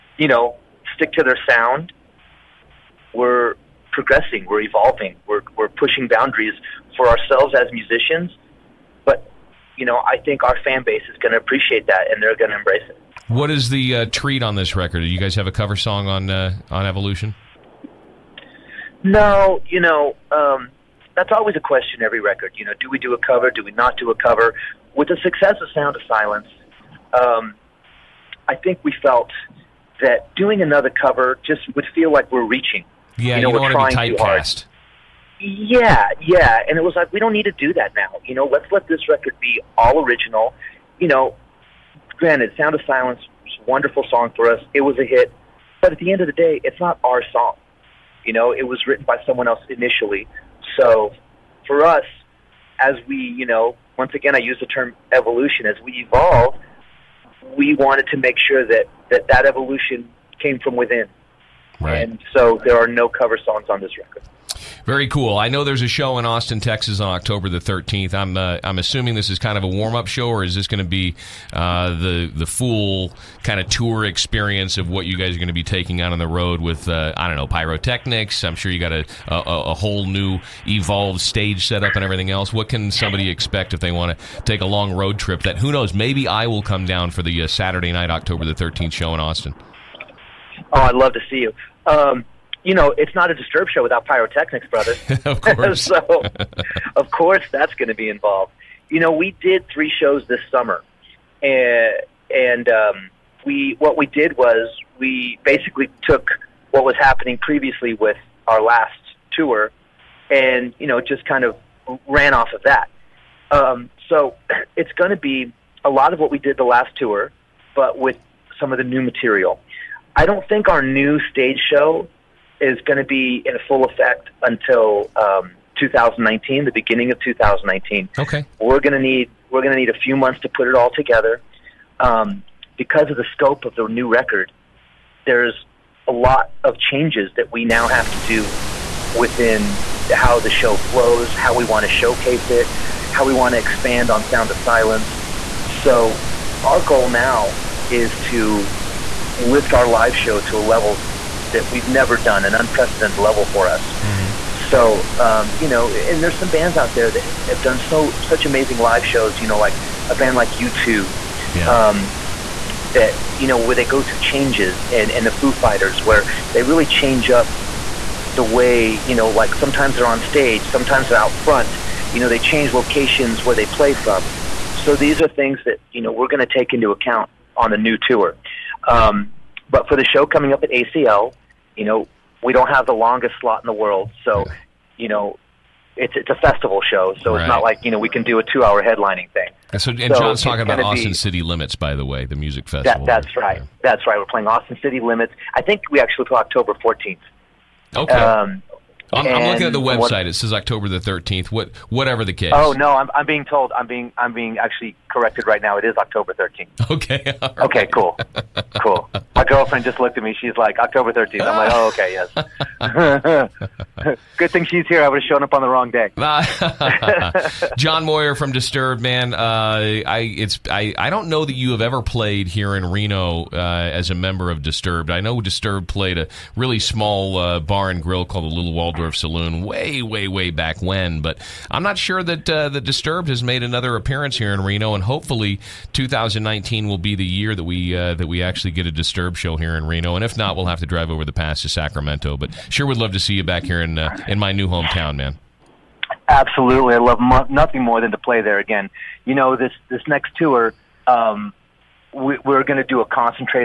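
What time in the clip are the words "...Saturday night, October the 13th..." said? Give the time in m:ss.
1:27.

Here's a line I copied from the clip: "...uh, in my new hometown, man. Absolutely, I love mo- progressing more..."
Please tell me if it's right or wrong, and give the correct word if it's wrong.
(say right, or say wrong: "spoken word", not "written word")
wrong: "nothing", not "progressing".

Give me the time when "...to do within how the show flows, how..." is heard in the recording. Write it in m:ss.
2:18.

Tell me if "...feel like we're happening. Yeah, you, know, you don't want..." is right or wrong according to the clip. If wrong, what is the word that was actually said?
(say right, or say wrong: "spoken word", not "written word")
wrong: "reaching", not "happening".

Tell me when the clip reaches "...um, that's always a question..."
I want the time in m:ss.
0:20.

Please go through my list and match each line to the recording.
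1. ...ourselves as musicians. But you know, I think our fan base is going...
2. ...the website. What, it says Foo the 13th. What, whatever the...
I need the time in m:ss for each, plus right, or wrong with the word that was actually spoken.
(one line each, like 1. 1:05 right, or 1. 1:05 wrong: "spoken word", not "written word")
1. 0:07 right
2. 3:19 wrong: "October", not "Foo".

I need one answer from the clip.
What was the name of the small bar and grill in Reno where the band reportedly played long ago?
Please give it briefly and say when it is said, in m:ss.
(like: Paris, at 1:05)
Little Waldorf Saloon, at 3:48.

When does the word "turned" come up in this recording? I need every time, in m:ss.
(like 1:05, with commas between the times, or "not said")
not said.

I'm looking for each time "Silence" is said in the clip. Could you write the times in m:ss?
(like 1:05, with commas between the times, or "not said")
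0:26, 0:42, 2:24.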